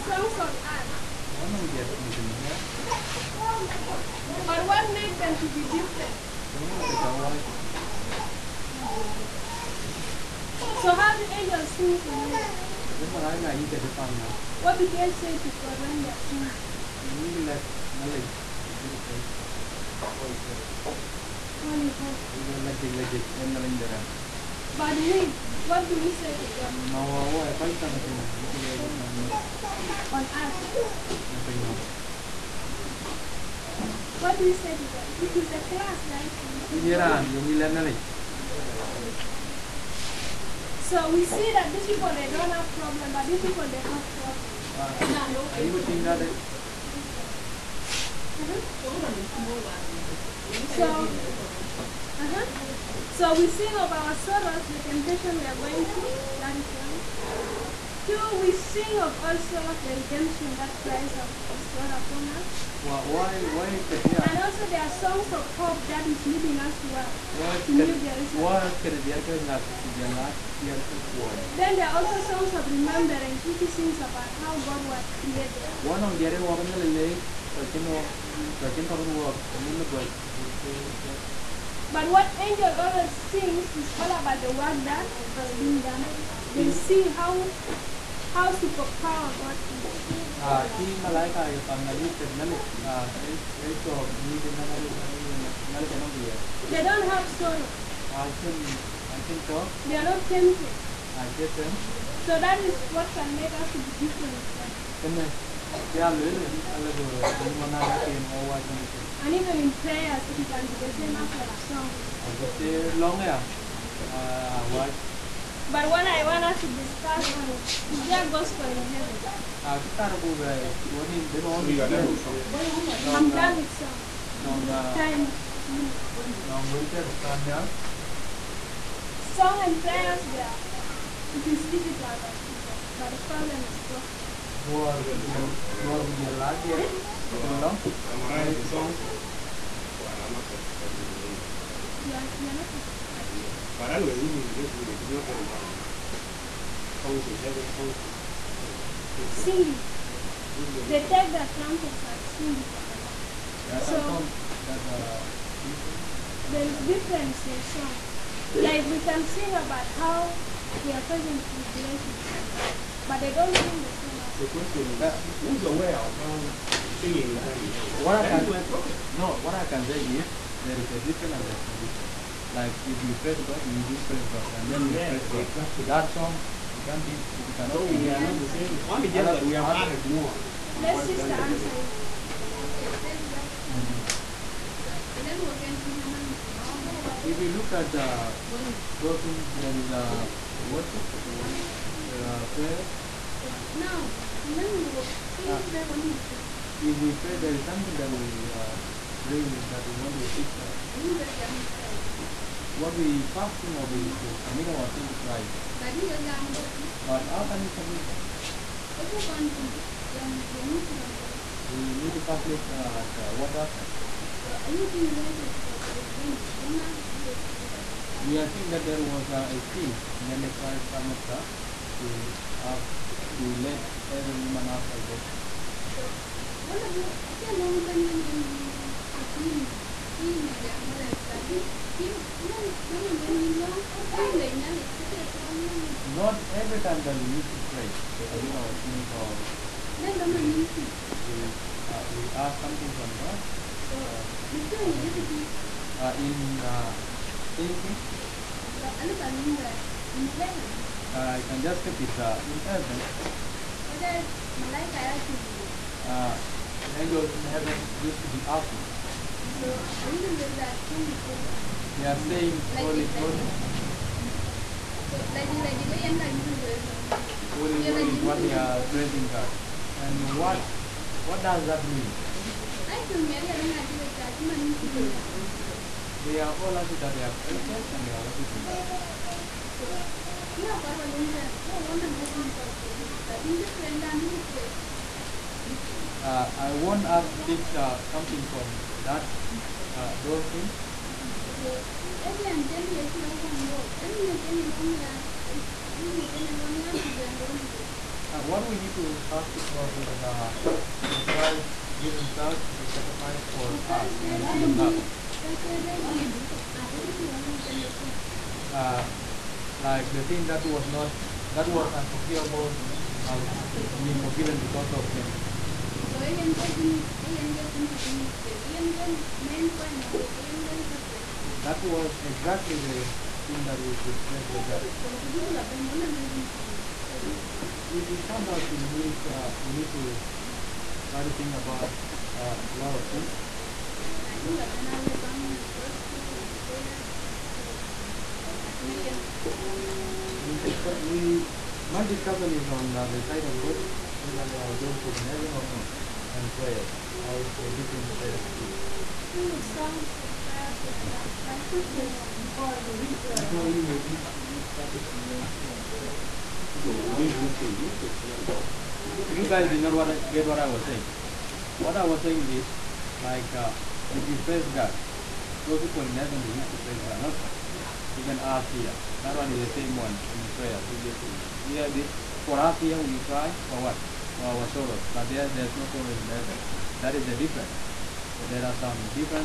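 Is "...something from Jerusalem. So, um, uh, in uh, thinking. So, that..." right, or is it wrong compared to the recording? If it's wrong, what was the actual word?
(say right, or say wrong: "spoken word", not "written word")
wrong: "God", not "Jerusalem".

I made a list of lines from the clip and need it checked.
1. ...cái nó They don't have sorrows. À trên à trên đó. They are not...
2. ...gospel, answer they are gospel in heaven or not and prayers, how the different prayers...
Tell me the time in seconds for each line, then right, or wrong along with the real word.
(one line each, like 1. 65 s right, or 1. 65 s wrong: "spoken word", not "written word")
1. 94 s right
2. 343 s wrong: "whether", not "answer".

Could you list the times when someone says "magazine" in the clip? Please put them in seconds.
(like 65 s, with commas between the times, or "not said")
not said.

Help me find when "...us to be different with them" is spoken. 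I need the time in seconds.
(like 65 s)
103 s.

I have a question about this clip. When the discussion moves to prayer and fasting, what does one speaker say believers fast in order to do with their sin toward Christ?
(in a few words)
submit our sin.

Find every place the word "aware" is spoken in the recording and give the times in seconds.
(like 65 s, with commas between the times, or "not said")
165 s.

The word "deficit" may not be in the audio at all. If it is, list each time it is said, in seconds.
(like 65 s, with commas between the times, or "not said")
not said.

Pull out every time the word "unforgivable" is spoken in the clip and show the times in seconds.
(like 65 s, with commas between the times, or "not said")
311 s.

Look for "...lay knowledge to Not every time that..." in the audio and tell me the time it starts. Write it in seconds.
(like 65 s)
234 s.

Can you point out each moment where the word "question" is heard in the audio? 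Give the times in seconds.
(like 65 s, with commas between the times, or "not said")
164 s, 351 s.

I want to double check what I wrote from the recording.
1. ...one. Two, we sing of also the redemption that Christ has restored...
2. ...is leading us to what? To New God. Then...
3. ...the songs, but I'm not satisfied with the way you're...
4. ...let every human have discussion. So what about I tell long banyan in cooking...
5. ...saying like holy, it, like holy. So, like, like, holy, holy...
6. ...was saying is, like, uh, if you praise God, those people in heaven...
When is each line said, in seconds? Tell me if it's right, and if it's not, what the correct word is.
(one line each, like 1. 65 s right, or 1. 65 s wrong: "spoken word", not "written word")
1. 56 s right
2. 66 s wrong: "Jerusalem", not "God"
3. 138 s right
4. 223 s wrong: "salvation", not "discussion"
5. 262 s right
6. 362 s right.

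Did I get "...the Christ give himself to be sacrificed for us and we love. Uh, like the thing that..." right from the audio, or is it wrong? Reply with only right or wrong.
right.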